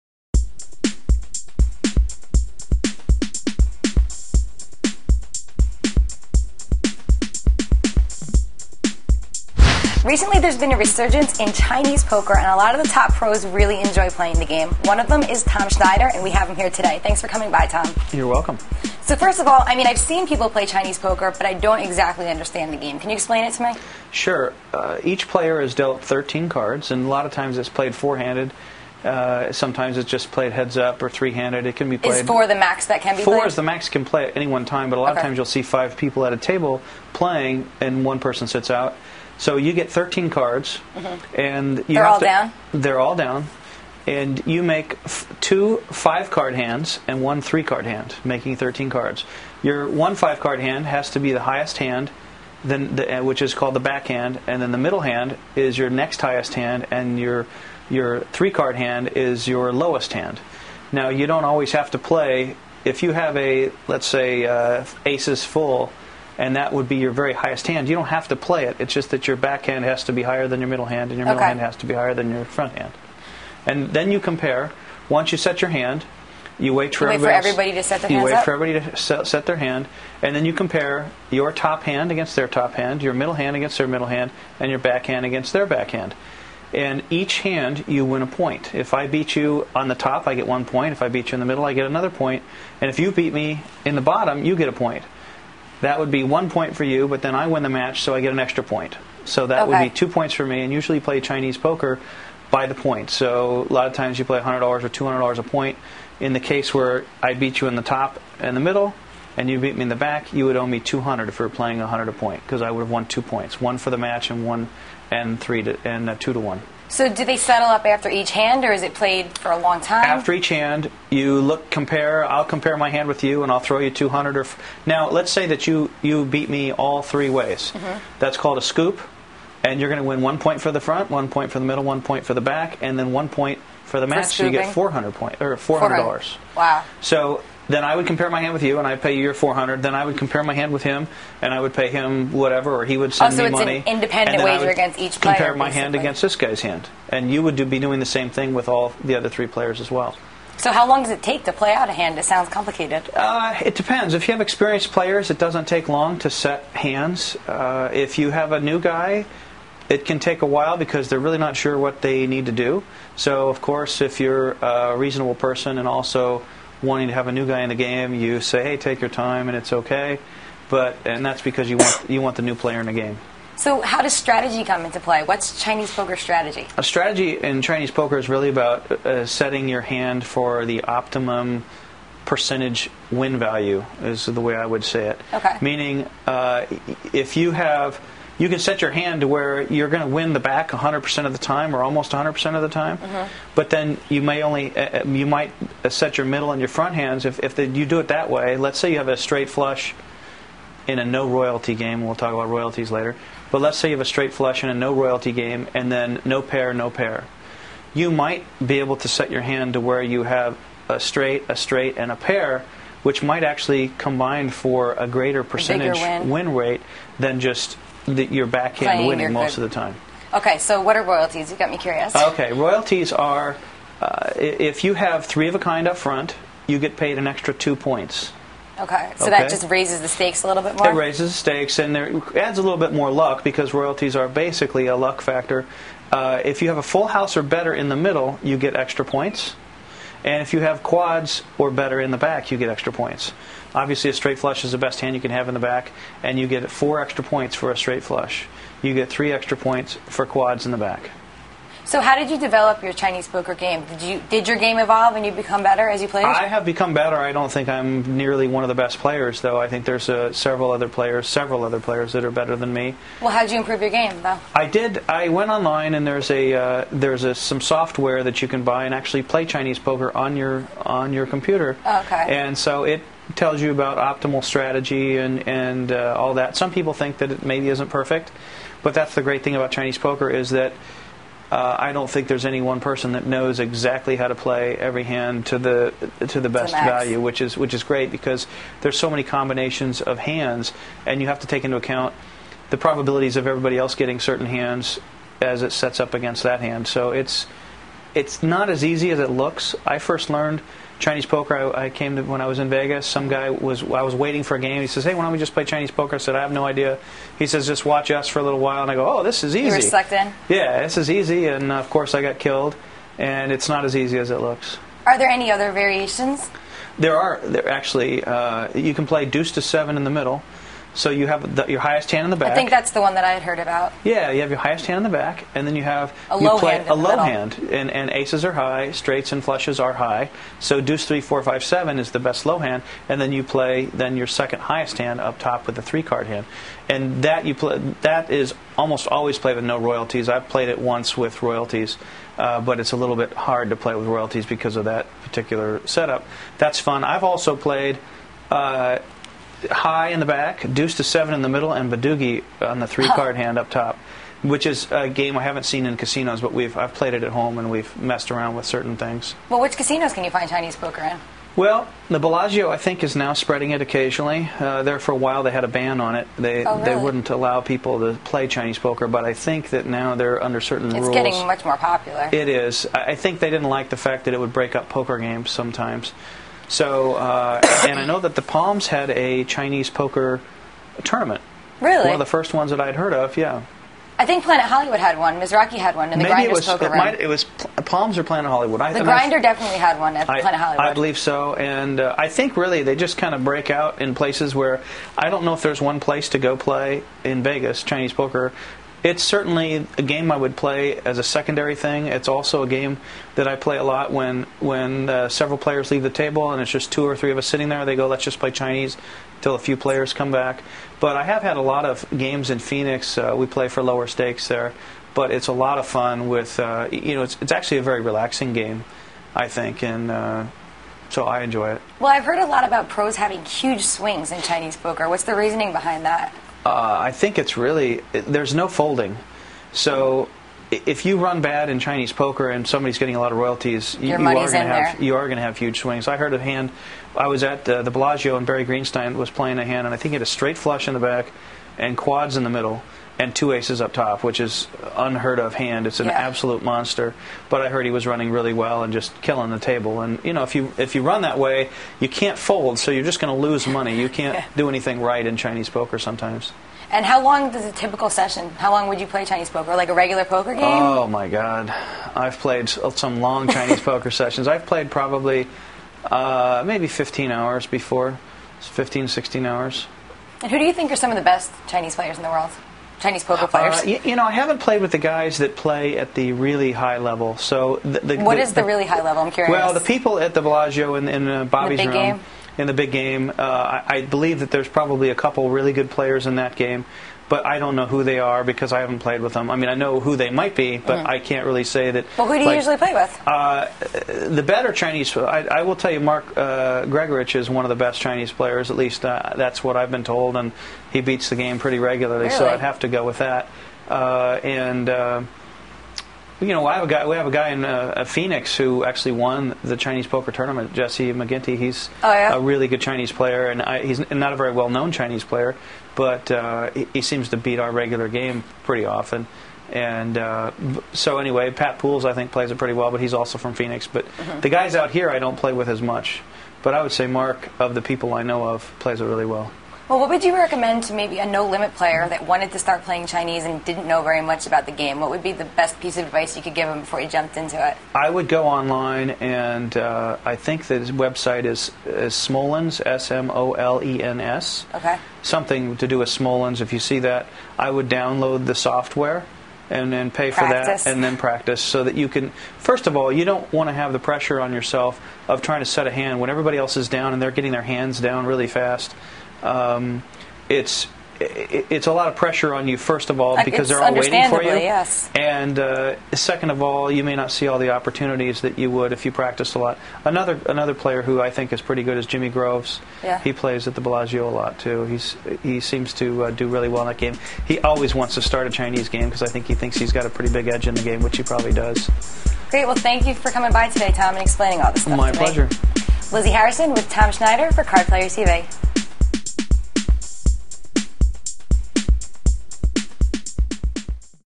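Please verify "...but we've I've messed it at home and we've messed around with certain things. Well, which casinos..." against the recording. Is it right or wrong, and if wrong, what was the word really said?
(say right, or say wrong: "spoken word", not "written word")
wrong: "played", not "messed".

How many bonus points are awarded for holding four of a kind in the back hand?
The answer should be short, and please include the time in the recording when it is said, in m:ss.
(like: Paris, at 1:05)
3, at 4:09.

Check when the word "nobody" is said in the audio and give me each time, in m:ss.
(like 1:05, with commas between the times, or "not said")
not said.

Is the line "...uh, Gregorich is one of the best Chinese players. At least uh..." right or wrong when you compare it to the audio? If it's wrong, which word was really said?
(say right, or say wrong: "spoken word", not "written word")
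right.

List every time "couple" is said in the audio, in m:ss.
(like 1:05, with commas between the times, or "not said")
8:05.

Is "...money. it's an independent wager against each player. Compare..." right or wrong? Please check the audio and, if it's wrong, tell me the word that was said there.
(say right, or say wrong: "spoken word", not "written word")
right.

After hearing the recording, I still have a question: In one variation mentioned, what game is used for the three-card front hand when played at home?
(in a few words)
Badugi.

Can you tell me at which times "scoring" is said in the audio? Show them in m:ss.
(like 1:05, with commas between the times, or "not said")
not said.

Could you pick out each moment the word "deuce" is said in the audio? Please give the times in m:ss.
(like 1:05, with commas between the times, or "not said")
5:19, 5:30, 5:50.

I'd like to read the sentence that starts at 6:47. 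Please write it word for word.
They go, let's just play Chinese until a few players come back.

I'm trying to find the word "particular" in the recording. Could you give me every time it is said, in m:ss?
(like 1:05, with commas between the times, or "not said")
5:45.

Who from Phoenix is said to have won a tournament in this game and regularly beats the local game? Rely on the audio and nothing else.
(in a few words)
Jesse McGinty.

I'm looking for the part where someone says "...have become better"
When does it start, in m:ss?
4:16.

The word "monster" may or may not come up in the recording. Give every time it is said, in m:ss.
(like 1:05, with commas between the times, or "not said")
7:26.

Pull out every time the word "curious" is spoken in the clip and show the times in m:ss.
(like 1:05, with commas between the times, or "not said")
3:41, 7:59.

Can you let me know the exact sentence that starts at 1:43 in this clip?
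So a lot of times you play $100 or $200 a point.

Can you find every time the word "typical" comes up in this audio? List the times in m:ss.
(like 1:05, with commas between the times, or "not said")
7:37.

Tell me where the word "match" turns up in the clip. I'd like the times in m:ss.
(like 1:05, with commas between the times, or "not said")
1:37, 1:53, 2:14.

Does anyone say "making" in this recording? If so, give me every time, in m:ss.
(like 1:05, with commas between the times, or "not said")
0:48.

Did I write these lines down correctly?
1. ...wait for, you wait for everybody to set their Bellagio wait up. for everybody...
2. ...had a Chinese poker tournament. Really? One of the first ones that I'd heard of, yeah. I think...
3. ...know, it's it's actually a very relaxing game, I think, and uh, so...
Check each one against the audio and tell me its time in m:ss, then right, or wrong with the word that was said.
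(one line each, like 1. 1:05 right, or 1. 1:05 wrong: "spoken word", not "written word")
1. 1:16 wrong: "You", not "Bellagio"
2. 6:18 right
3. 6:57 right.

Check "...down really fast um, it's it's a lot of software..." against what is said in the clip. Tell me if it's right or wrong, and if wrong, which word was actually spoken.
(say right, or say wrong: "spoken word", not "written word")
wrong: "pressure", not "software".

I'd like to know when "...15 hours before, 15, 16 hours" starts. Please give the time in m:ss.
7:46.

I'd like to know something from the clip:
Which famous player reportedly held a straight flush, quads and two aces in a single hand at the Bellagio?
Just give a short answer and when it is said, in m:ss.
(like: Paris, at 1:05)
Barry Greenstein, at 7:18.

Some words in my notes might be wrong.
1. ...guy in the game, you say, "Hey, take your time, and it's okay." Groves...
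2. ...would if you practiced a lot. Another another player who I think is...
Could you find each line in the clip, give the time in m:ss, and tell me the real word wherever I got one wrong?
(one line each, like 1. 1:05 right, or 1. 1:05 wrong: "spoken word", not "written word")
1. 2:47 wrong: "But", not "Groves"
2. 9:28 right.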